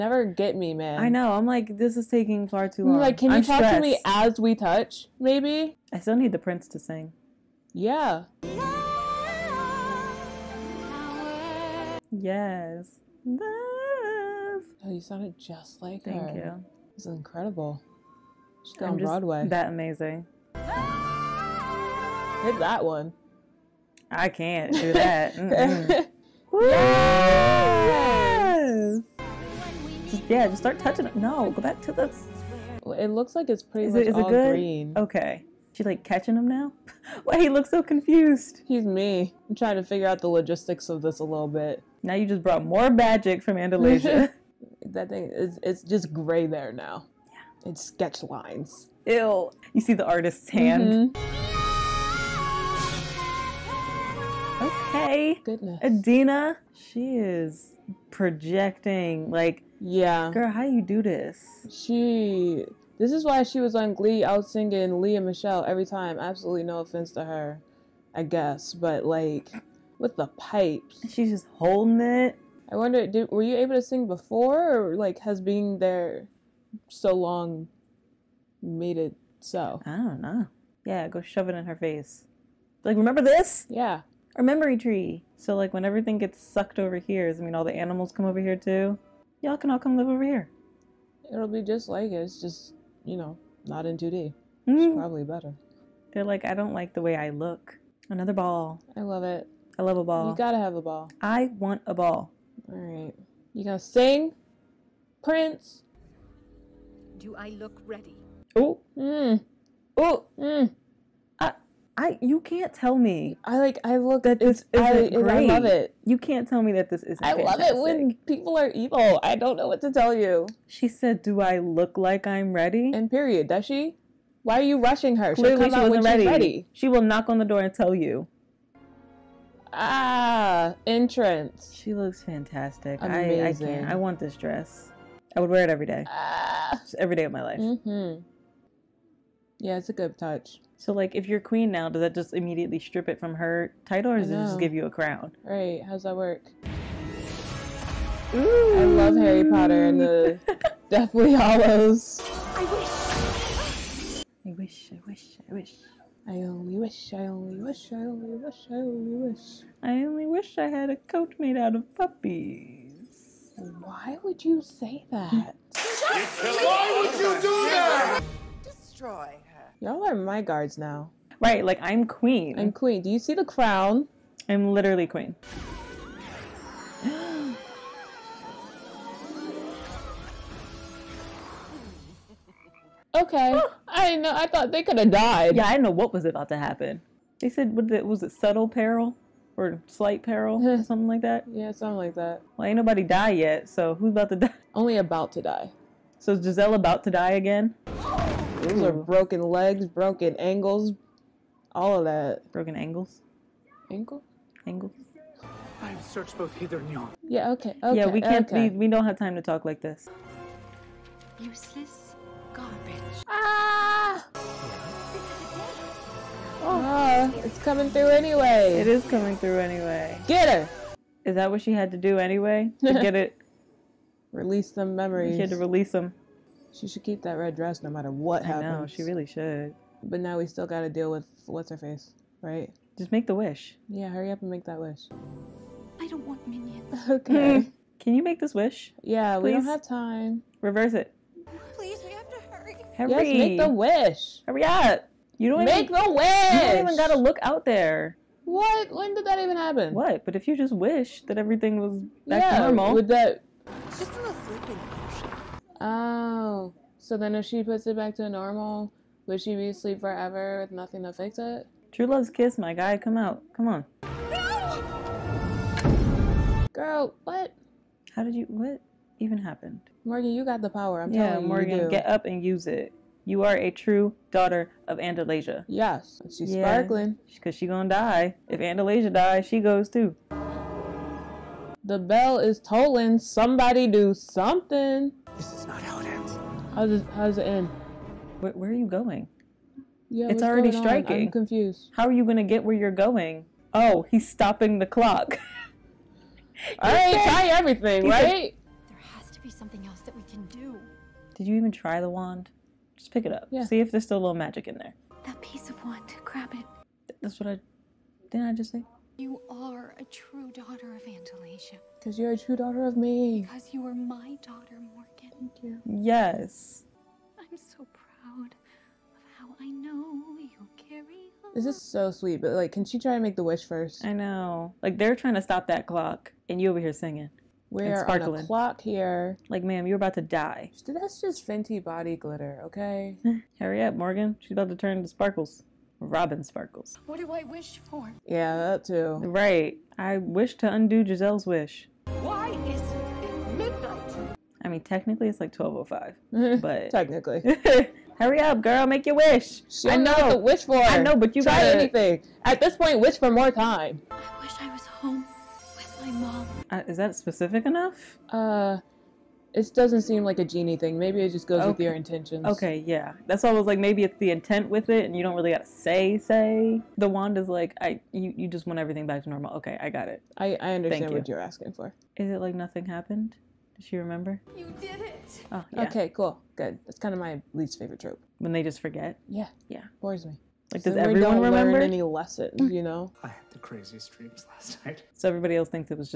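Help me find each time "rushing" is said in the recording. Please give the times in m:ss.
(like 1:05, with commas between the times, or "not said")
2:04.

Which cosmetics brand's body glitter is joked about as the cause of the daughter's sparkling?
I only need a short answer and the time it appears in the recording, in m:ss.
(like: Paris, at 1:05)
Fenty, at 5:31.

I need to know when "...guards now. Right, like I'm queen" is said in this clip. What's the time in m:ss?
2:50.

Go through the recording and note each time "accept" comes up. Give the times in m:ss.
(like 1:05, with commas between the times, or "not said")
not said.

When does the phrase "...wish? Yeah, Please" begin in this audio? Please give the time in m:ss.
3:58.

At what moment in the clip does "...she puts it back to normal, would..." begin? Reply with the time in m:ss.
4:17.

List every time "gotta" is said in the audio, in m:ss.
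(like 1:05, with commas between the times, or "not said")
1:40, 3:50, 4:06, 6:05.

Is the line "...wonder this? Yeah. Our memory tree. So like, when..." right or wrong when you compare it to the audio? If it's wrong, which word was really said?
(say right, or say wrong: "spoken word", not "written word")
wrong: "remember", not "wonder".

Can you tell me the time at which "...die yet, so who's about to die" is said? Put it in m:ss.
3:13.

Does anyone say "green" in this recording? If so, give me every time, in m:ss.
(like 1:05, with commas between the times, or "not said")
0:34.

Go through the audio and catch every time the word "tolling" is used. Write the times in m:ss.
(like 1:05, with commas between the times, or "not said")
4:42.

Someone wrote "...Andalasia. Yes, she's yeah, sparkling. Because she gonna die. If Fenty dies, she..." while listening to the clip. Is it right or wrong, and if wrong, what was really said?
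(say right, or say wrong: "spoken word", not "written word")
wrong: "Andalasia", not "Fenty".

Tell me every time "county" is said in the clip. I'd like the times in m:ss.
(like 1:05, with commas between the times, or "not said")
not said.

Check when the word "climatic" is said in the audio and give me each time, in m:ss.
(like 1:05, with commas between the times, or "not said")
not said.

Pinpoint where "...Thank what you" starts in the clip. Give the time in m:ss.
6:11.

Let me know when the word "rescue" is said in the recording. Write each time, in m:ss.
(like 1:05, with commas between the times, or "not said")
not said.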